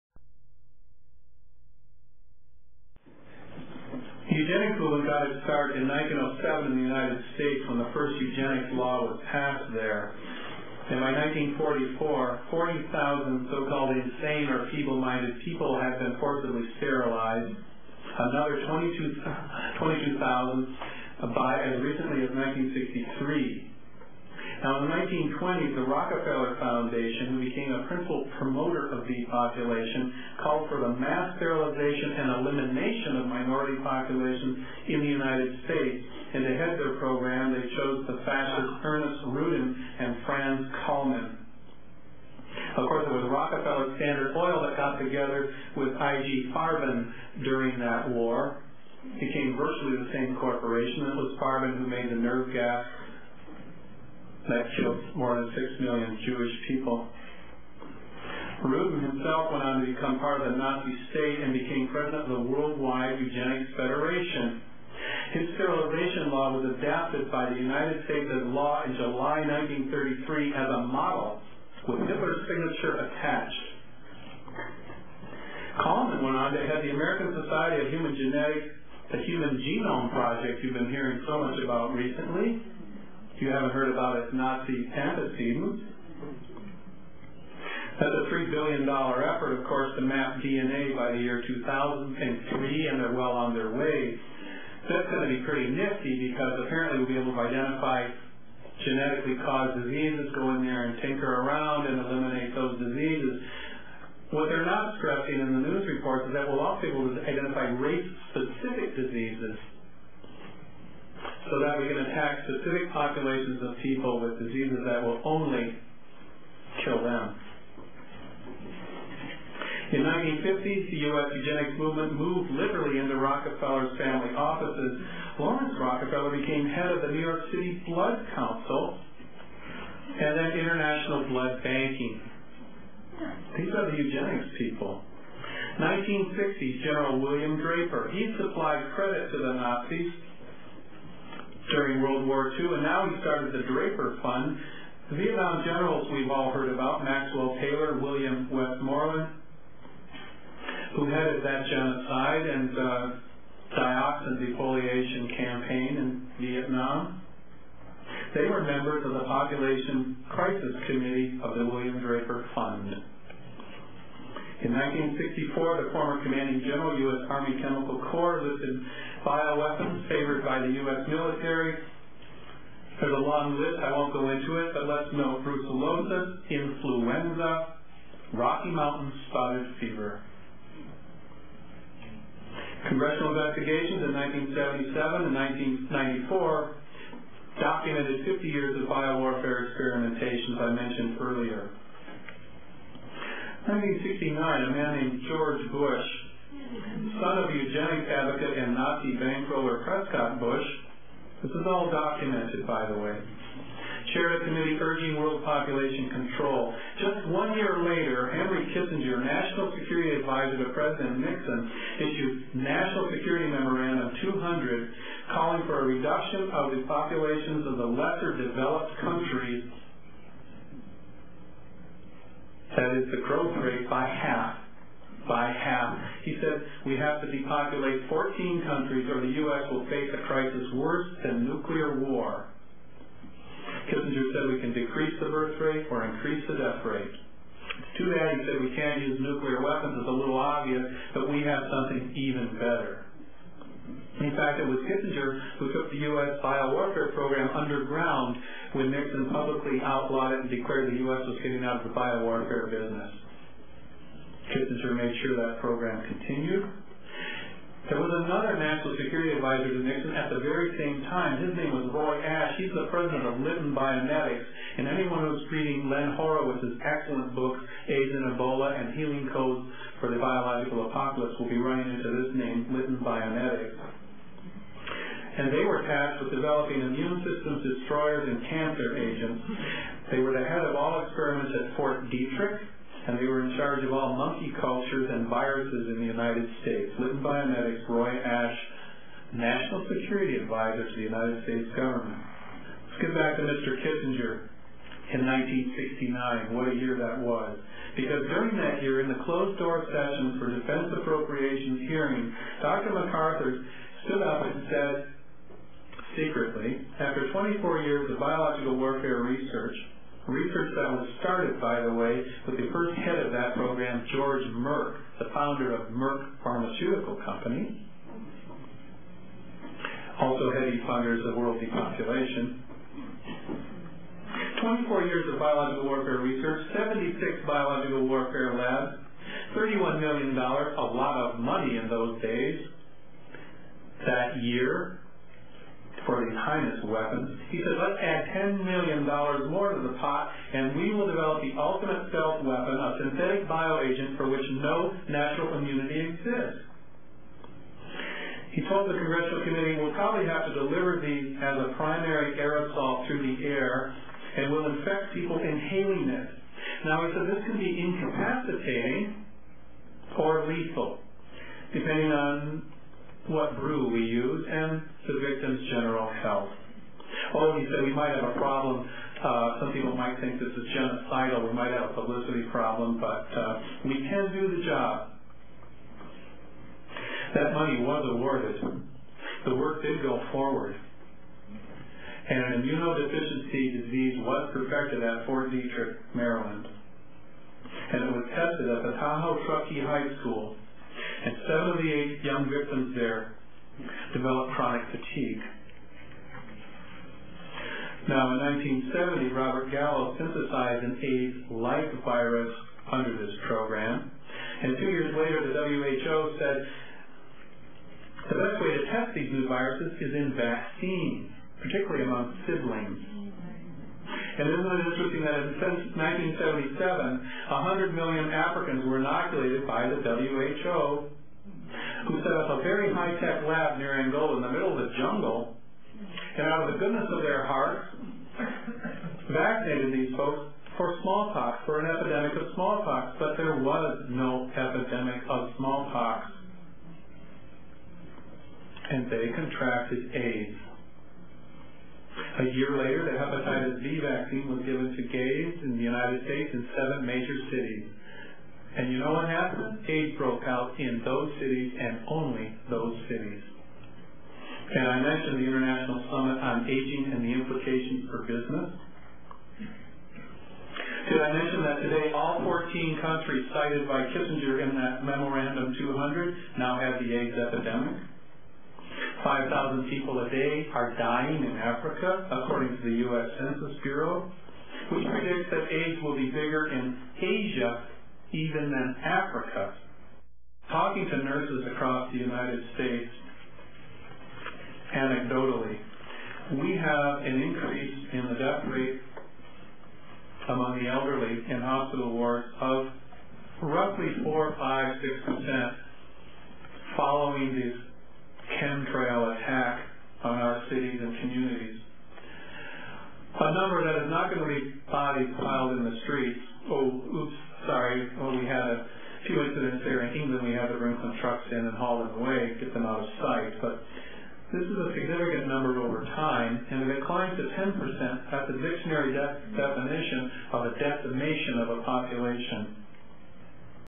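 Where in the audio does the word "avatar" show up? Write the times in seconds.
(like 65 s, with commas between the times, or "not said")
not said.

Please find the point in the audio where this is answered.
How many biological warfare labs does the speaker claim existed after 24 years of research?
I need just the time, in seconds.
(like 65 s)
326 s.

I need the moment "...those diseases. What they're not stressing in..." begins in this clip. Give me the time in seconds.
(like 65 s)
102 s.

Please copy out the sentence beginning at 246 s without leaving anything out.
biowarfare program underground when Nixon publicly outlawed it and declared the U.S.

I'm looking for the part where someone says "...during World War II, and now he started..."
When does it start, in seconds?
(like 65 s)
141 s.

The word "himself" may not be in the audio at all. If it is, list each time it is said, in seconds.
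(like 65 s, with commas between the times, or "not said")
59 s.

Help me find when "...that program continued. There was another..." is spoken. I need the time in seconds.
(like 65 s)
255 s.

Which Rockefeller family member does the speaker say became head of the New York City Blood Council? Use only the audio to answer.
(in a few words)
Laurance Rockefeller.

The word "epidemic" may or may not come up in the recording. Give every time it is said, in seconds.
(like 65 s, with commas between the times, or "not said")
467 s.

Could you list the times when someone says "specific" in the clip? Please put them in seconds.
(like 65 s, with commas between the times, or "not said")
107 s, 112 s.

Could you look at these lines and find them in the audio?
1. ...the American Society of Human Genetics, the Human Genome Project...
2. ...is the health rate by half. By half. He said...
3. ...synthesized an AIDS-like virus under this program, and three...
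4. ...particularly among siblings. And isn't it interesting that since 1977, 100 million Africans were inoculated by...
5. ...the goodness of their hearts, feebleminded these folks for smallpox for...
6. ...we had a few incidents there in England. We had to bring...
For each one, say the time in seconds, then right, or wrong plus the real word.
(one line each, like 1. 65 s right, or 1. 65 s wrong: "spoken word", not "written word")
1. 76 s right
2. 223 s wrong: "growth", not "health"
3. 400 s wrong: "two", not "three"
4. 411 s right
5. 426 s wrong: "vaccinated", not "feebleminded"
6. 508 s right.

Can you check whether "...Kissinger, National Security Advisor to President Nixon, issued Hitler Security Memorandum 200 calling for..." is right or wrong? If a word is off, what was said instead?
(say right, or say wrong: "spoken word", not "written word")
wrong: "National", not "Hitler".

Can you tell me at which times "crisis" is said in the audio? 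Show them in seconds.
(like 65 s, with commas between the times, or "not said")
160 s, 230 s.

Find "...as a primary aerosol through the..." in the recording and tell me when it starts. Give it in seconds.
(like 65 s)
351 s.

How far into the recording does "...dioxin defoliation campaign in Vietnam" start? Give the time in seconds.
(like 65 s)
153 s.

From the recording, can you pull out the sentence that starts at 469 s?
5,000 people a day are dying in Africa, according to the U.S.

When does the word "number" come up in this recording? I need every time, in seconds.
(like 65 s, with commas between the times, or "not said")
503 s, 515 s.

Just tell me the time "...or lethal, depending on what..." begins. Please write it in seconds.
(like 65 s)
360 s.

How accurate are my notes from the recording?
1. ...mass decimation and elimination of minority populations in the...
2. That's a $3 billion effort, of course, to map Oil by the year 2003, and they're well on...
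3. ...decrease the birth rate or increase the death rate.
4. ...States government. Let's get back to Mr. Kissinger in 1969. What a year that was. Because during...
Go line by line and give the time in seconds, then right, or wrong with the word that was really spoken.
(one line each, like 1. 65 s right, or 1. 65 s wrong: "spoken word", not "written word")
1. 31 s wrong: "sterilization", not "decimation"
2. 87 s wrong: "DNA", not "Oil"
3. 234 s right
4. 291 s right.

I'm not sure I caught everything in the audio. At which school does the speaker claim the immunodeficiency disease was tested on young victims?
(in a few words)
Tahoe Truckee High School.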